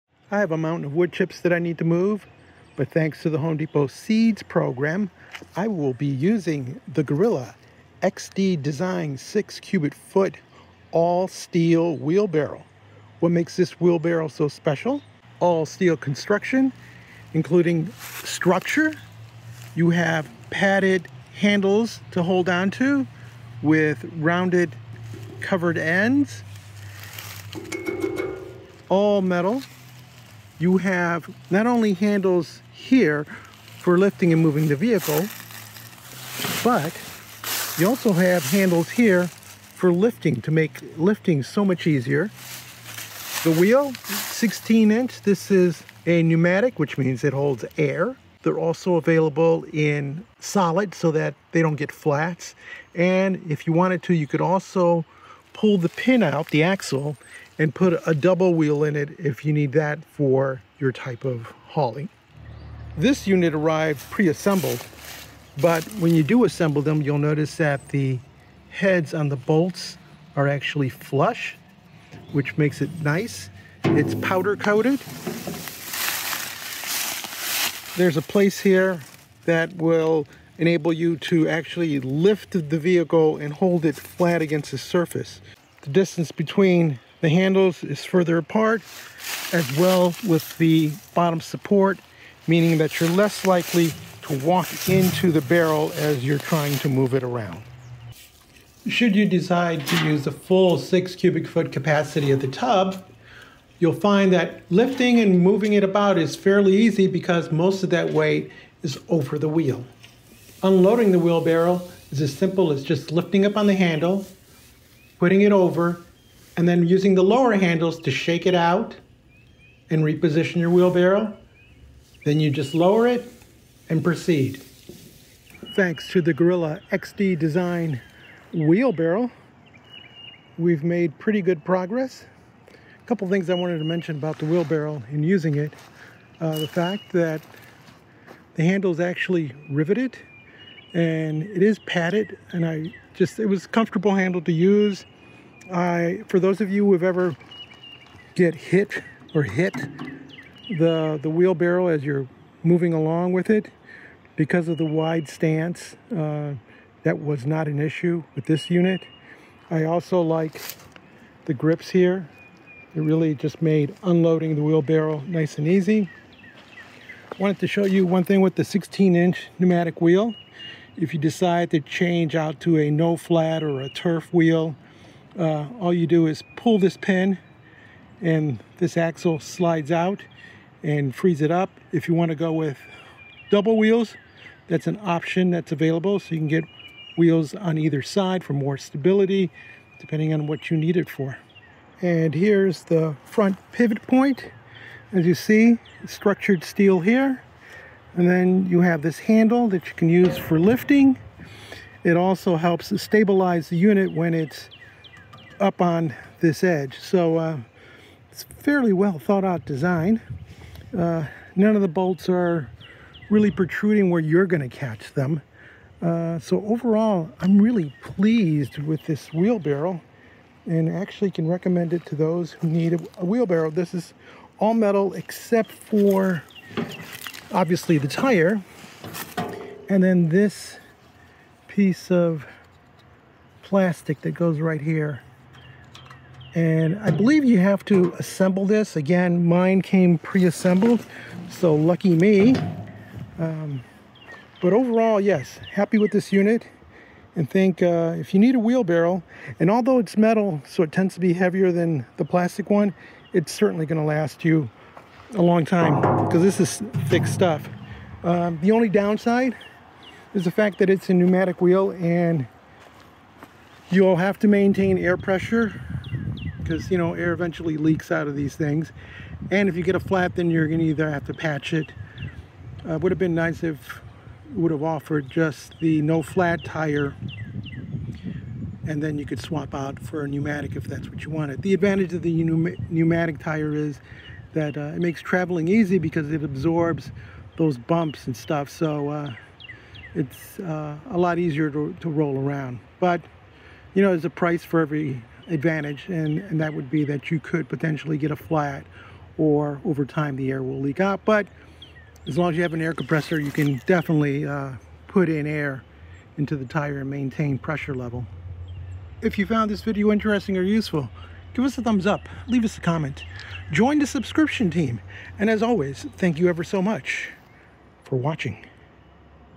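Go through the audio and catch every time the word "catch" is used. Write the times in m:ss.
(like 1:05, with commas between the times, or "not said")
3:34.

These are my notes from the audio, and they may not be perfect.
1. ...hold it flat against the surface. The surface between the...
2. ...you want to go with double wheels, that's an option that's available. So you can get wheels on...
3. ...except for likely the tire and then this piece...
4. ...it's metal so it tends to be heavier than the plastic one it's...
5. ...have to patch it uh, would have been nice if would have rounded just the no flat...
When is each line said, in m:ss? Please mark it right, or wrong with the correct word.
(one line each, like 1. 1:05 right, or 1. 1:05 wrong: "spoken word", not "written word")
1. 1:23 wrong: "distance", not "surface"
2. 3:02 right
3. 3:45 wrong: "obviously", not "likely"
4. 4:09 right
5. 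4:31 wrong: "offered", not "rounded".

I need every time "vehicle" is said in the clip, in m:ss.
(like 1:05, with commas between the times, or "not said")
0:34, 1:22.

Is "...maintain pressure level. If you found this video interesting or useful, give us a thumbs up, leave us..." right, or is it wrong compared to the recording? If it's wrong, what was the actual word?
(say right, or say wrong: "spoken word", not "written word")
right.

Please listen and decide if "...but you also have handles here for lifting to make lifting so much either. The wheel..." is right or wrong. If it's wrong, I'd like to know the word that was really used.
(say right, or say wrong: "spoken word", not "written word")
wrong: "easier", not "either".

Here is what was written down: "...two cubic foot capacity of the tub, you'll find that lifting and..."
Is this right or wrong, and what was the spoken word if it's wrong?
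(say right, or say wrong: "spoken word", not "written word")
wrong: "six", not "two".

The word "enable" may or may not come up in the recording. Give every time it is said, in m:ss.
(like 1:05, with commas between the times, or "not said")
1:20.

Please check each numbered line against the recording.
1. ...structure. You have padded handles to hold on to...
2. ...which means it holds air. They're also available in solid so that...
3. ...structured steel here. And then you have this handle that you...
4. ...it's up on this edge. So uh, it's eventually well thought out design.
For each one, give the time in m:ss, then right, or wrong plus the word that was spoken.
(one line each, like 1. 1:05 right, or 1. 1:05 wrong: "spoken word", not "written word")
1. 0:18 right
2. 0:46 right
3. 3:16 right
4. 3:24 wrong: "fairly", not "eventually".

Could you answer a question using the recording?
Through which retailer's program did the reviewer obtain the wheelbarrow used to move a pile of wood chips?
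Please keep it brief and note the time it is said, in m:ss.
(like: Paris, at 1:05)
Home Depot Seeds program, at 0:03.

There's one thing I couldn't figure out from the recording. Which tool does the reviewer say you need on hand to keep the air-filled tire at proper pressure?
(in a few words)
Air compressor.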